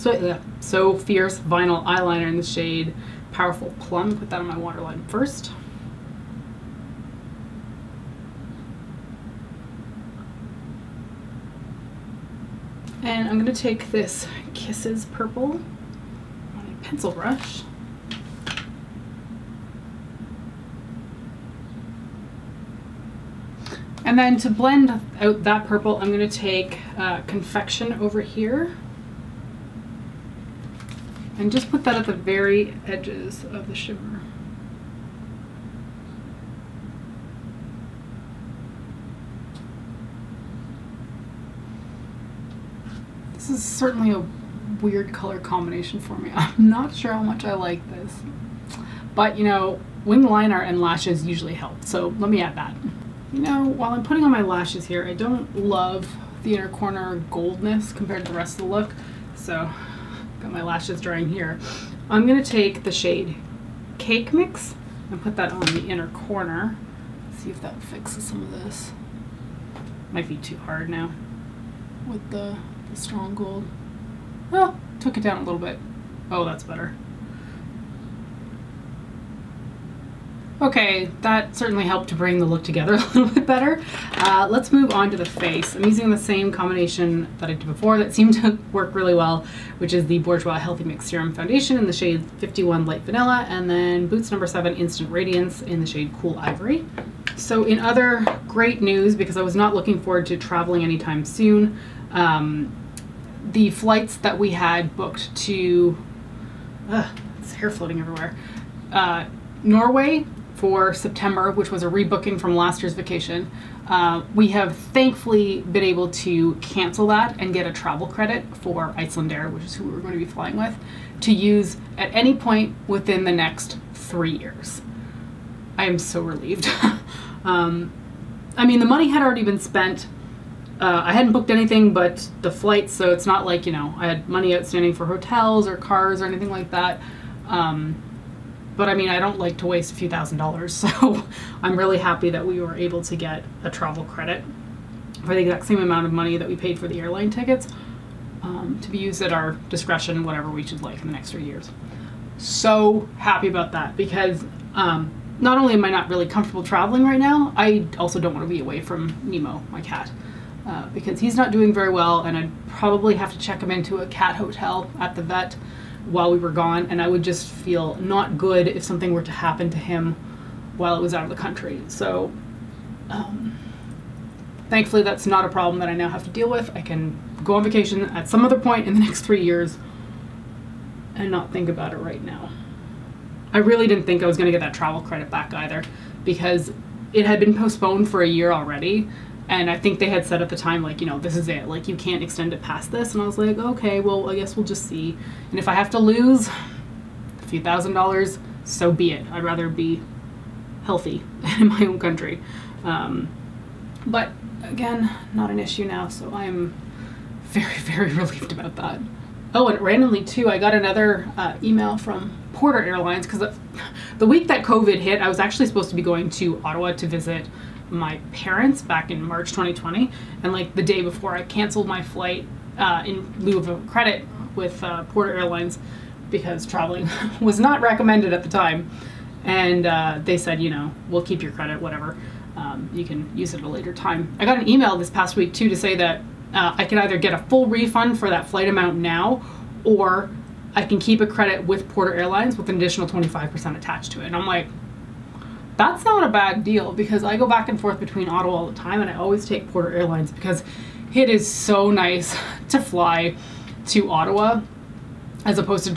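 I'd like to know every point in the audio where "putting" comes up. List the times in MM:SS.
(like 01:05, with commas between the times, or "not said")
00:54.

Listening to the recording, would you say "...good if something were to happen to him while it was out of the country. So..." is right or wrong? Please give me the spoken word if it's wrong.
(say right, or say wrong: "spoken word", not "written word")
right.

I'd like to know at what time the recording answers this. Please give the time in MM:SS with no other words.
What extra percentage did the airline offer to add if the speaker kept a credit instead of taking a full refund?
04:03.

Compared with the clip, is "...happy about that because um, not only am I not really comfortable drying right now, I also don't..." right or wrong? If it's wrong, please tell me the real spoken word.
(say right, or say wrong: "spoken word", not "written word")
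wrong: "traveling", not "drying".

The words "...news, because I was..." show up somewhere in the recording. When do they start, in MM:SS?
01:38.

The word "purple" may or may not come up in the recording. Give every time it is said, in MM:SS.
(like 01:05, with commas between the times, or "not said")
00:15, 00:25.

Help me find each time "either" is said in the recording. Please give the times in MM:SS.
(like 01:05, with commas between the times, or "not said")
03:05, 03:56.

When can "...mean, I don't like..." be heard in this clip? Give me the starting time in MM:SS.
02:18.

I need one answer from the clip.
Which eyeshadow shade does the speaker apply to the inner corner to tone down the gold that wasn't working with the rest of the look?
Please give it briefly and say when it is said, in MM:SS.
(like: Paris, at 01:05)
Cake Mix, at 01:03.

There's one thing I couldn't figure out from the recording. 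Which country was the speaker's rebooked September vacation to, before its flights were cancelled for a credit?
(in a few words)
Norway.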